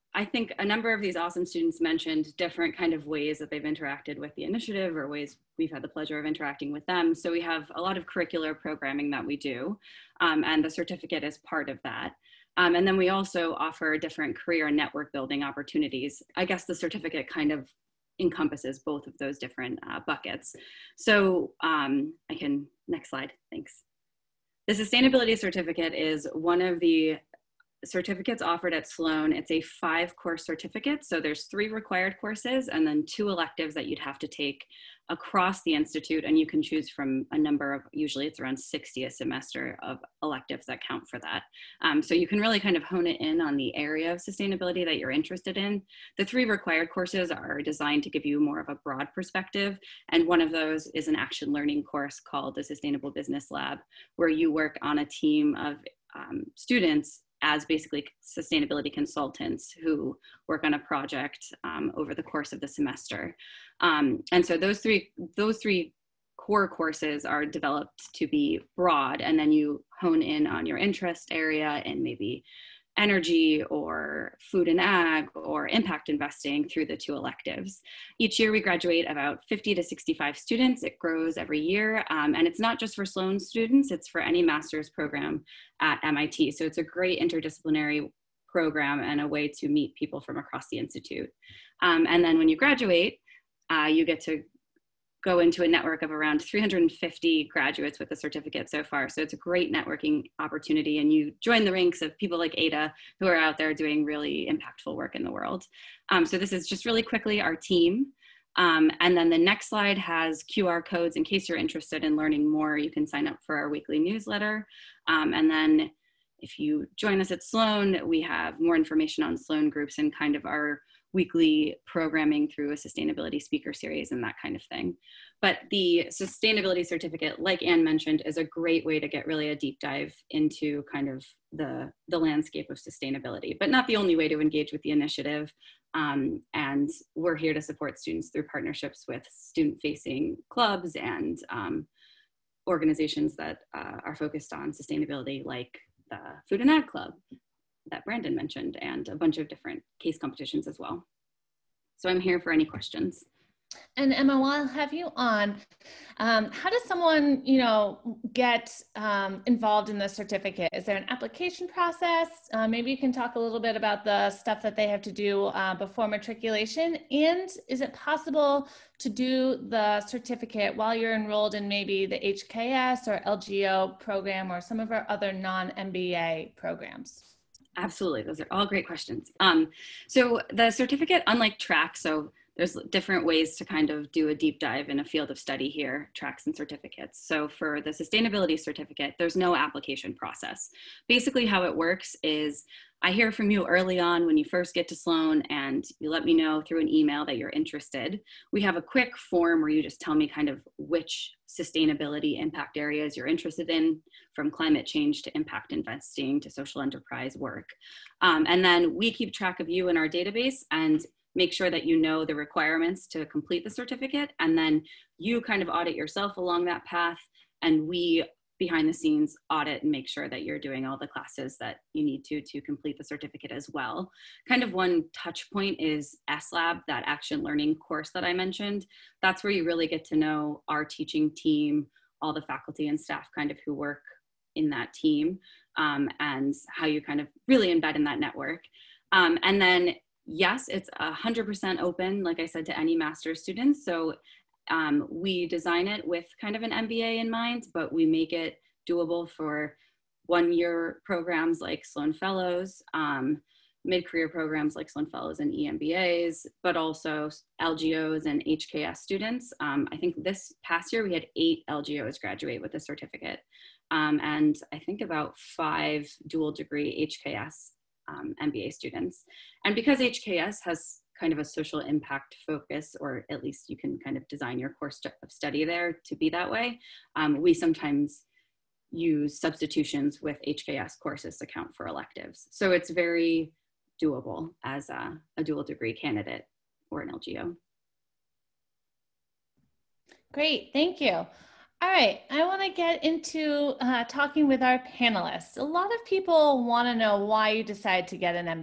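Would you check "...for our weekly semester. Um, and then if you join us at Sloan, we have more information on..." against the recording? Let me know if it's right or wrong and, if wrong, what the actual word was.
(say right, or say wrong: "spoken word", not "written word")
wrong: "newsletter", not "semester".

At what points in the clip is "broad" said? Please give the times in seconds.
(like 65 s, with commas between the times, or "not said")
48 s, 68 s.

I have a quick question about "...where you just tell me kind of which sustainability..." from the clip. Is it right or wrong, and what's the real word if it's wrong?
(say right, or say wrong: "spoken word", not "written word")
right.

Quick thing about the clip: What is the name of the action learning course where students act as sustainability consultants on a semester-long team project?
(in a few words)
Sustainable Business Lab.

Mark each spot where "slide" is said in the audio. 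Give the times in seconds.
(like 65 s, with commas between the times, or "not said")
23 s, 109 s.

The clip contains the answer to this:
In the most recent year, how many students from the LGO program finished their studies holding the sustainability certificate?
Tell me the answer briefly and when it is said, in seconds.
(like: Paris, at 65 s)
8, at 261 s.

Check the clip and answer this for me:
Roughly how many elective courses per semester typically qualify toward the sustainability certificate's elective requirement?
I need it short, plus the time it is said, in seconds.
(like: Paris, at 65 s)
60, at 38 s.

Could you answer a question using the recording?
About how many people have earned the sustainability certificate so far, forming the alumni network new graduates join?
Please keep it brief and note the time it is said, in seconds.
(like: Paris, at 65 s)
350, at 96 s.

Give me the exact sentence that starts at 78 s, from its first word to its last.
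Each year we graduate about 50 to 65 students.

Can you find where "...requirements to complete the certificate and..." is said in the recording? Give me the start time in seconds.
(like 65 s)
212 s.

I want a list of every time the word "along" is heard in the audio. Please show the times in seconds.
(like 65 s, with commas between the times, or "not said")
216 s.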